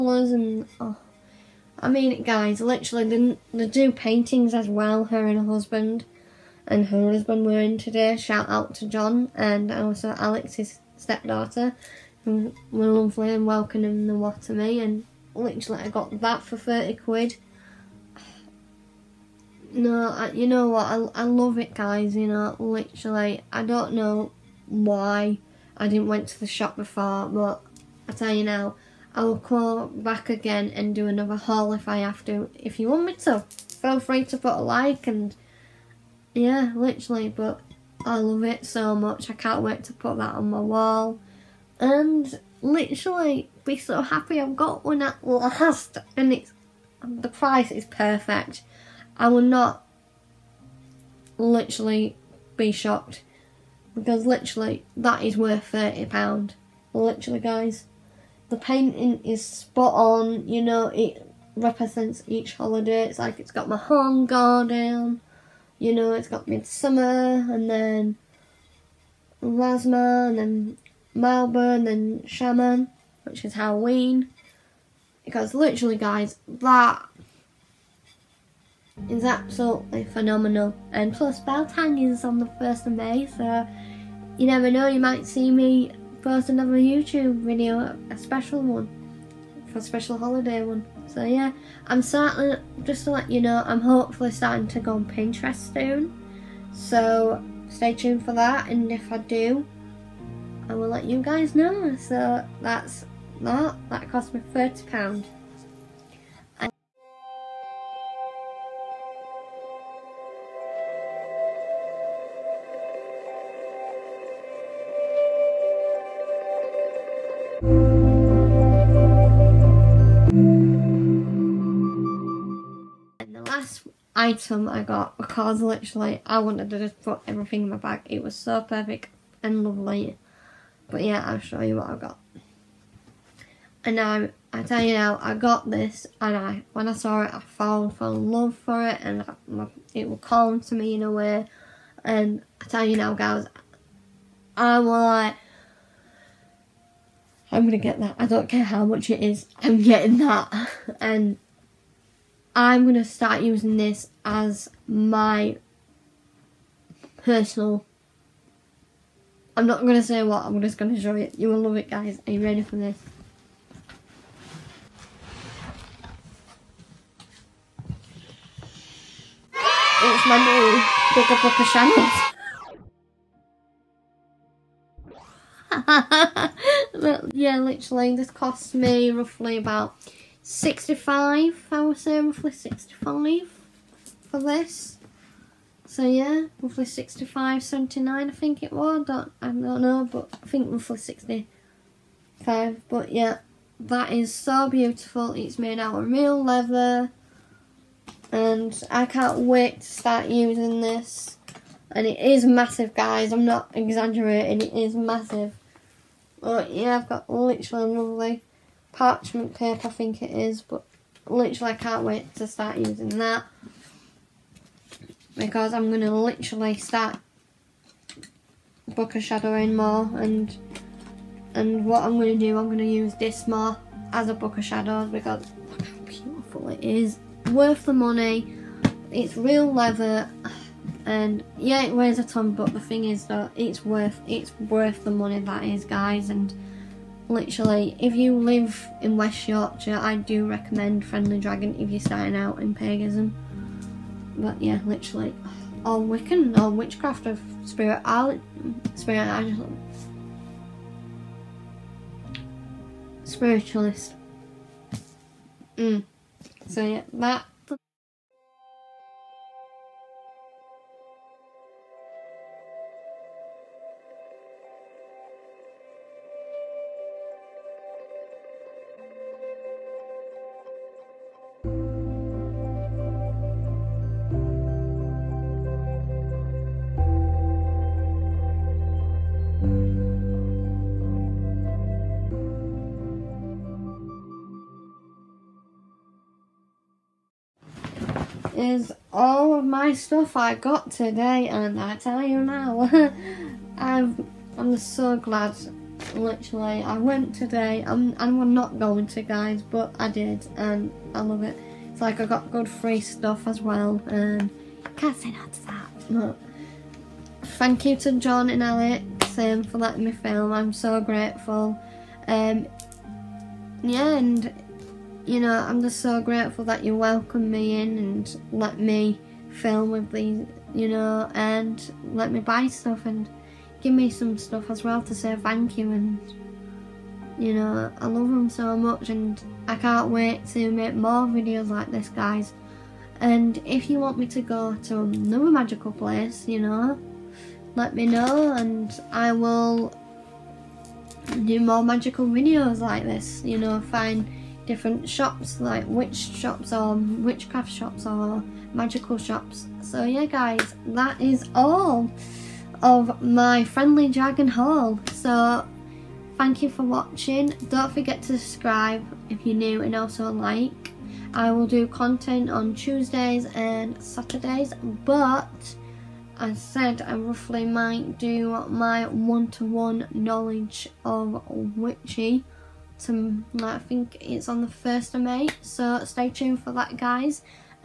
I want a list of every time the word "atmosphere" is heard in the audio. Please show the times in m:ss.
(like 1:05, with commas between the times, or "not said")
not said.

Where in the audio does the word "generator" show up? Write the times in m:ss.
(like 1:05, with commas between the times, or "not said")
not said.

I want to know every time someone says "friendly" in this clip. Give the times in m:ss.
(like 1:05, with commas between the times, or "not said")
4:01, 5:53.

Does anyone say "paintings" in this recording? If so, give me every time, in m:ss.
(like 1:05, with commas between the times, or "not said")
0:03, 0:58.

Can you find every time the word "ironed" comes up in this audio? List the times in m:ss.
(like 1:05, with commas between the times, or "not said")
not said.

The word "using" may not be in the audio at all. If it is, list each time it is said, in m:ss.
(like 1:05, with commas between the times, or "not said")
2:33, 3:20, 3:32.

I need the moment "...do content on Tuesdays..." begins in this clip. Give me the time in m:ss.
6:01.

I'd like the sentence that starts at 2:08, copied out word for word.
It was so perfect and lovely.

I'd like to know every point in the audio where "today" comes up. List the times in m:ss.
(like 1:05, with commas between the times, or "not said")
0:07, 4:50, 4:57.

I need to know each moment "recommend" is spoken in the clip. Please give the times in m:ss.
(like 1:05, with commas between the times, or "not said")
4:00.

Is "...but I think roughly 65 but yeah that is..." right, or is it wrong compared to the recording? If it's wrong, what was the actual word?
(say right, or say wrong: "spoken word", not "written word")
right.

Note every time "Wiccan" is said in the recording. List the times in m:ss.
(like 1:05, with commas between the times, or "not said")
4:05.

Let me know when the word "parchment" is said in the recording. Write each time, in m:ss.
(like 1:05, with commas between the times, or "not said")
3:28.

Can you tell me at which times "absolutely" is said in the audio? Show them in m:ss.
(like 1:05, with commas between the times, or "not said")
1:19.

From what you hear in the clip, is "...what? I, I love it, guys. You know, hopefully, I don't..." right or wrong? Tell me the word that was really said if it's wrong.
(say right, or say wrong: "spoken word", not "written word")
wrong: "literally", not "hopefully".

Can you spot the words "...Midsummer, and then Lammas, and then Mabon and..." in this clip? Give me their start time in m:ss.
1:06.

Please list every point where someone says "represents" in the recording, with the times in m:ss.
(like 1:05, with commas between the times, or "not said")
1:01.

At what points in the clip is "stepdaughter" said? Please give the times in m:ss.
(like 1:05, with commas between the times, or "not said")
0:10.